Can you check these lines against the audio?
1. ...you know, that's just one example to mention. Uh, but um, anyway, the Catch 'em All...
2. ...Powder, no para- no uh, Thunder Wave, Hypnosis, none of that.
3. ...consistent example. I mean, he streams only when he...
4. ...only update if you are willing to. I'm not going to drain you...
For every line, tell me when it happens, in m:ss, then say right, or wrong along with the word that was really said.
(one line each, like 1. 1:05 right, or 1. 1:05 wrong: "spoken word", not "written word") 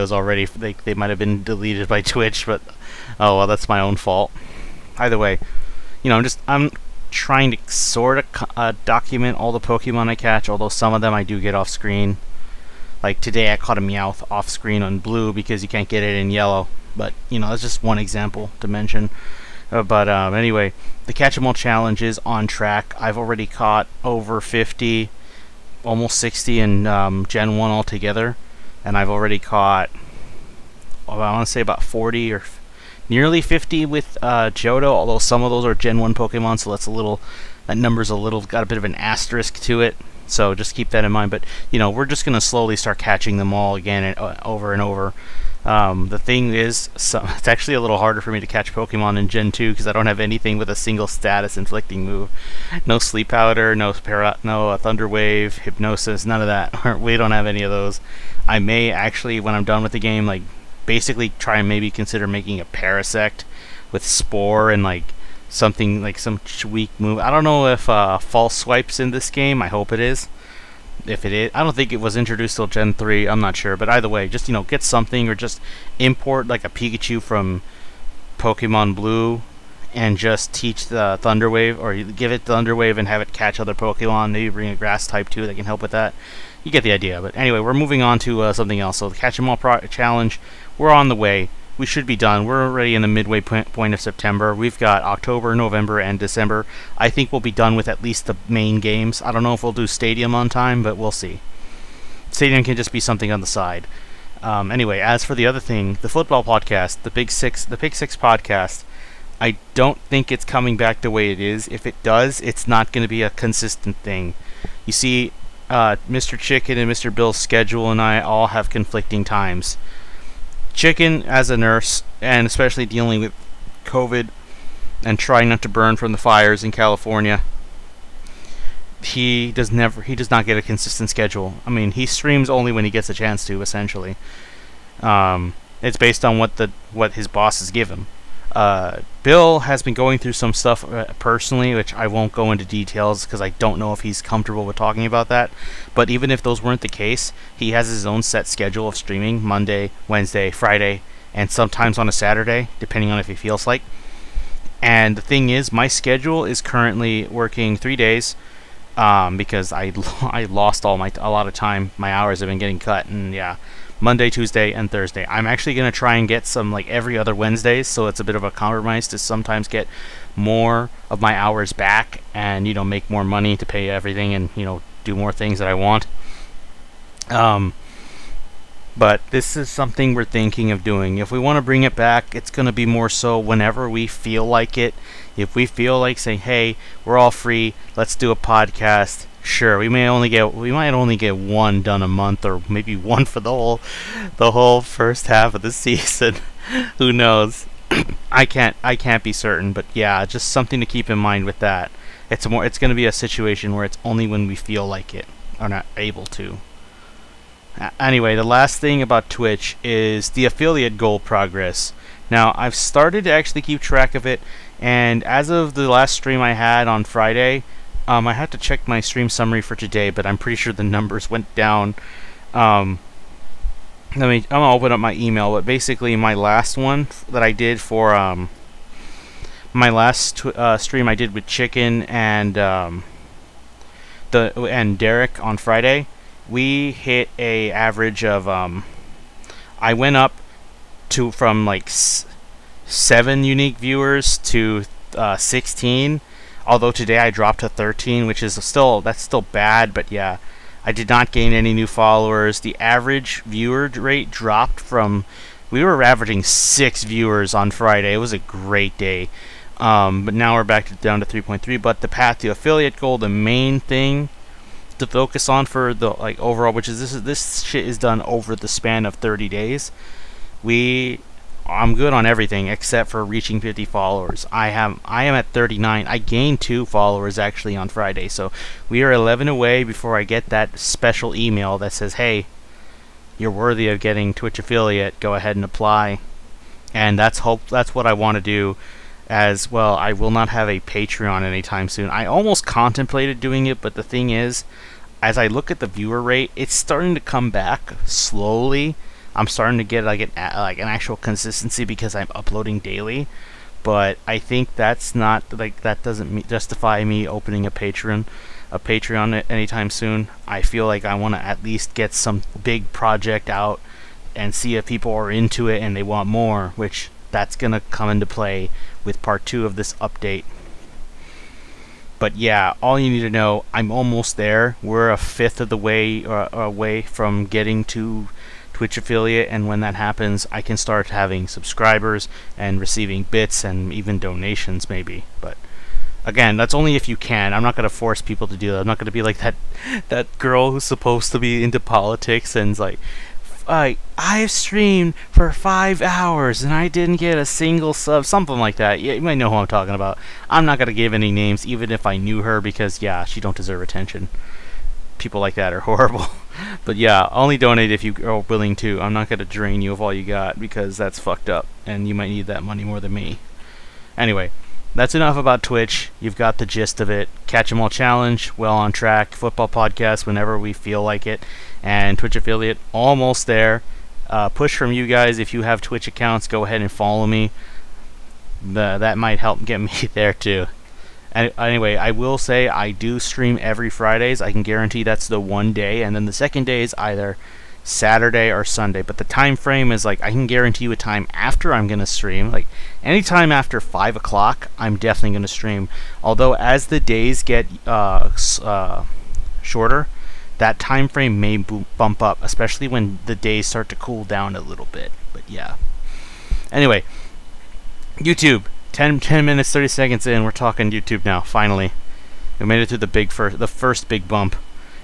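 1. 0:17 right
2. 0:53 right
3. 2:10 wrong: "schedule", not "example"
4. 5:57 wrong: "donate", not "update".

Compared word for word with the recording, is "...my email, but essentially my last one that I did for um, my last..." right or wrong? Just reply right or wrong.
wrong.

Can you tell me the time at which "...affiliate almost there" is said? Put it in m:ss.
6:12.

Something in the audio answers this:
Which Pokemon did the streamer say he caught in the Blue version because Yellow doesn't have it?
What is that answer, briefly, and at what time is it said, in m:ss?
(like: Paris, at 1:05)
Meowth, at 0:13.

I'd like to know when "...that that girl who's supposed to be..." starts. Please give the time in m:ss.
5:39.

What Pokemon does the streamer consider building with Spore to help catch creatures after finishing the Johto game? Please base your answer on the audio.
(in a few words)
Parasect.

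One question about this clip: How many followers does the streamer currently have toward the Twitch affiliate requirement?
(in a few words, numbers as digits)
39.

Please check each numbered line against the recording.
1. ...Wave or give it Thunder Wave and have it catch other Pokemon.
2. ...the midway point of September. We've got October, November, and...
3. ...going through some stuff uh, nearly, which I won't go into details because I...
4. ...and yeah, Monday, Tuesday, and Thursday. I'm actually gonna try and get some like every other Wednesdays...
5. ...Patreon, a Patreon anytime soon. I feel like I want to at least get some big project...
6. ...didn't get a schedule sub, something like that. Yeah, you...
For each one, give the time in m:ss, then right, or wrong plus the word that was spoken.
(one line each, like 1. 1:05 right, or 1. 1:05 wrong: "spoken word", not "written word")
1. 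1:21 right
2. 1:33 right
3. 2:19 wrong: "personally", not "nearly"
4. 2:43 right
5. 5:07 right
6. 5:46 wrong: "single", not "schedule".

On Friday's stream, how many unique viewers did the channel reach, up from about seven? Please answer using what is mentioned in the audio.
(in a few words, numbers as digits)
16.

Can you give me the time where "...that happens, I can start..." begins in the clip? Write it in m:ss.
5:29.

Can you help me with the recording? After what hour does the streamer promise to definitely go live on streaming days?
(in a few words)
5 o'clock.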